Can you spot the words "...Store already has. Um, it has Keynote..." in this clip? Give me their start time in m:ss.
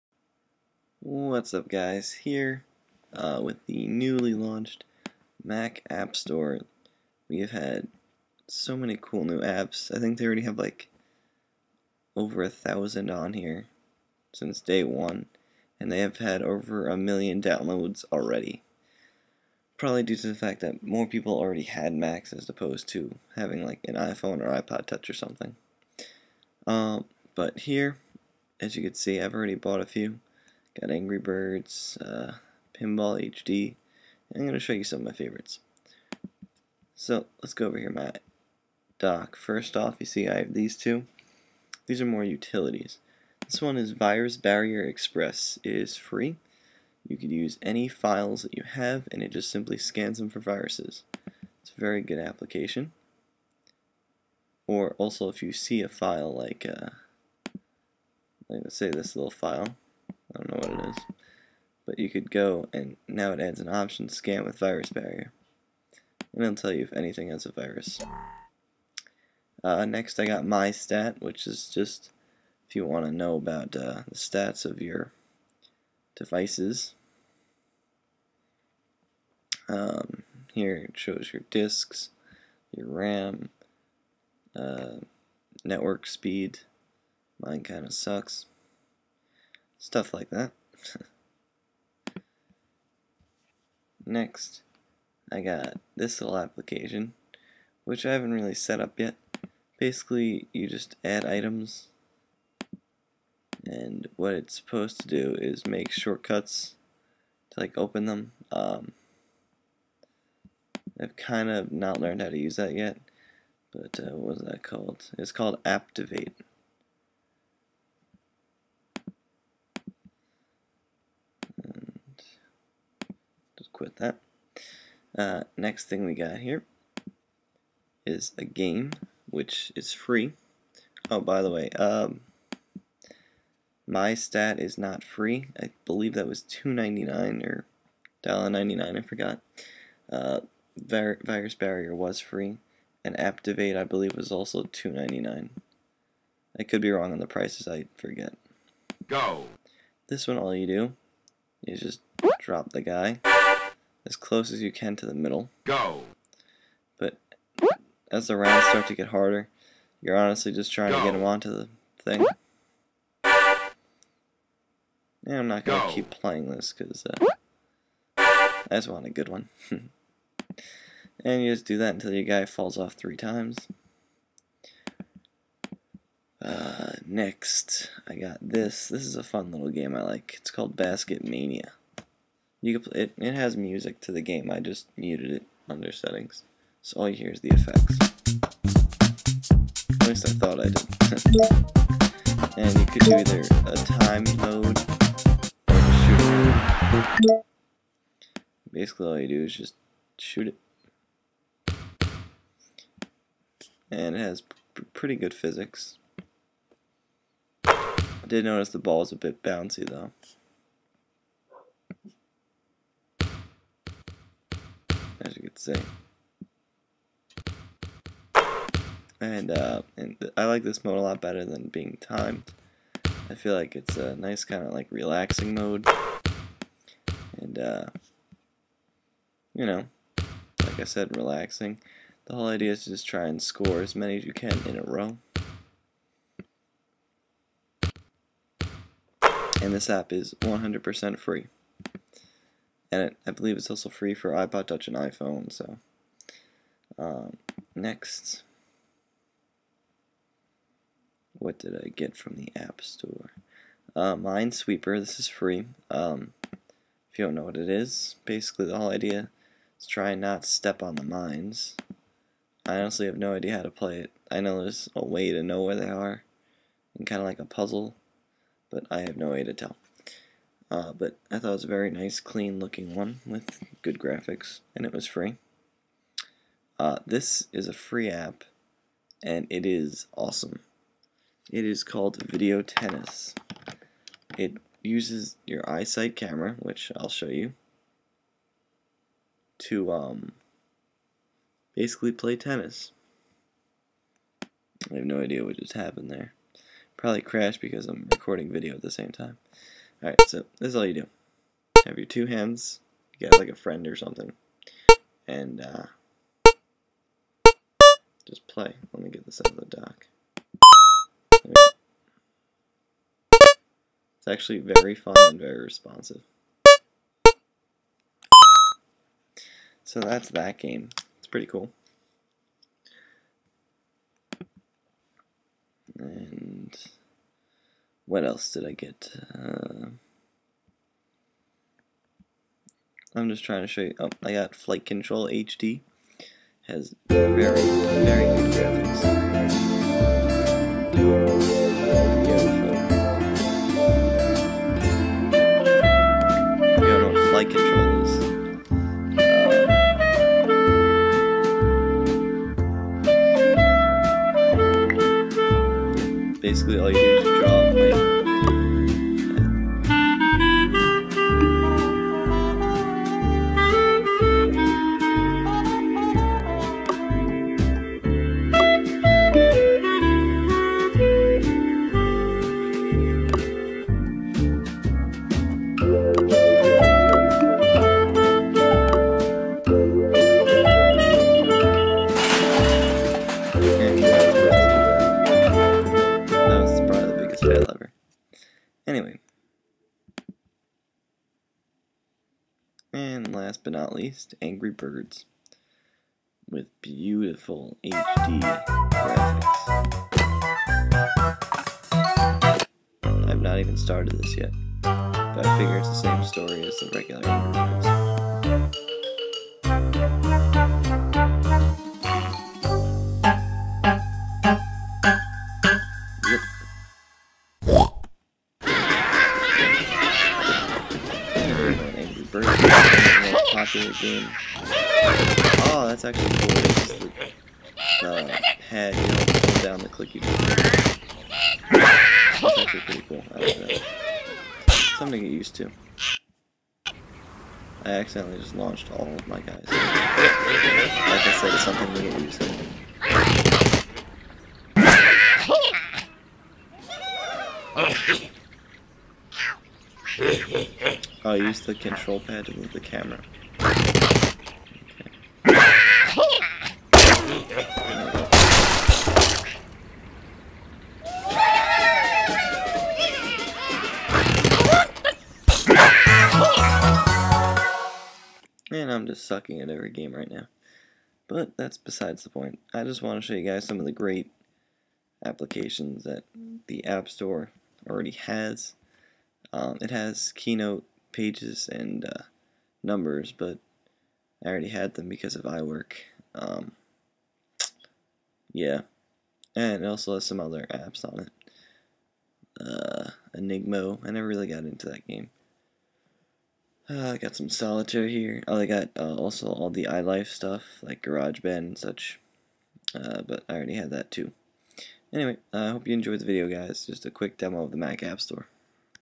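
7:57.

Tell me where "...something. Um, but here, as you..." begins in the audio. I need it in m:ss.
0:25.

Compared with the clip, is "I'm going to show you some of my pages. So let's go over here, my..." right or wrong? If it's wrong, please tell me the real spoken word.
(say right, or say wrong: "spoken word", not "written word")
wrong: "favorites", not "pages".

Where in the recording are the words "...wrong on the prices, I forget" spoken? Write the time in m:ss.
2:26.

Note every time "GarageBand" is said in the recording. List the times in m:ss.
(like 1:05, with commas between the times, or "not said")
8:21.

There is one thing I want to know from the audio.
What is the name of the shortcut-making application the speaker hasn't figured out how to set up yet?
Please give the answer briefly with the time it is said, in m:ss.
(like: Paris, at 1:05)
Activate, at 1:55.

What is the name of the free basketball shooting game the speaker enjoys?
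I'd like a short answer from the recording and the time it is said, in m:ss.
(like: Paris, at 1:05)
Basket Mania, at 3:00.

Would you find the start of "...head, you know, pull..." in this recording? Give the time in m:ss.
7:08.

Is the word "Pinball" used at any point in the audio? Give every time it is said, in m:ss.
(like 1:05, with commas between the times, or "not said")
0:32.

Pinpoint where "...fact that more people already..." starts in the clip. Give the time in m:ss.
0:20.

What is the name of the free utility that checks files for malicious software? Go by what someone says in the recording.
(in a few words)
Virus Barrier Express.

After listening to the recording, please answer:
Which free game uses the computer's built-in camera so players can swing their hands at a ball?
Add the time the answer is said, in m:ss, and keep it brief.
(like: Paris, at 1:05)
Video Tennis, at 4:42.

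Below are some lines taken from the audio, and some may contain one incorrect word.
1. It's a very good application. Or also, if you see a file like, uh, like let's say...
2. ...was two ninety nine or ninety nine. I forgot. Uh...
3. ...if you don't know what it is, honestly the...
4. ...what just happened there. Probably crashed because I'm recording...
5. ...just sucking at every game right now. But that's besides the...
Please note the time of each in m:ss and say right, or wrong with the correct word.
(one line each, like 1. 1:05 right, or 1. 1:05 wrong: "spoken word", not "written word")
1. 0:51 right
2. 2:16 right
3. 4:17 wrong: "basically", not "honestly"
4. 4:55 right
5. 7:49 right.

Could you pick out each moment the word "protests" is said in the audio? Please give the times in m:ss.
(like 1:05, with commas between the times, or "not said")
not said.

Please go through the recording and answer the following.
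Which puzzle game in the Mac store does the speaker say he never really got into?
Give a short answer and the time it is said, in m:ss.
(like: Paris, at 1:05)
Enigmo, at 8:13.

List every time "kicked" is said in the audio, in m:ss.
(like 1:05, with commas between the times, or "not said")
not said.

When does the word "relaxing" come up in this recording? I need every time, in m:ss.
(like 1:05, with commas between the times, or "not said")
3:44, 3:51.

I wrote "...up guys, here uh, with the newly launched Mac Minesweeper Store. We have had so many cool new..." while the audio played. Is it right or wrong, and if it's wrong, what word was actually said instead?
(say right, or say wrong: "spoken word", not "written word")
wrong: "App", not "Minesweeper".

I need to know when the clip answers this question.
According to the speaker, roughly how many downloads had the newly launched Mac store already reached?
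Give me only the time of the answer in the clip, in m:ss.
0:16.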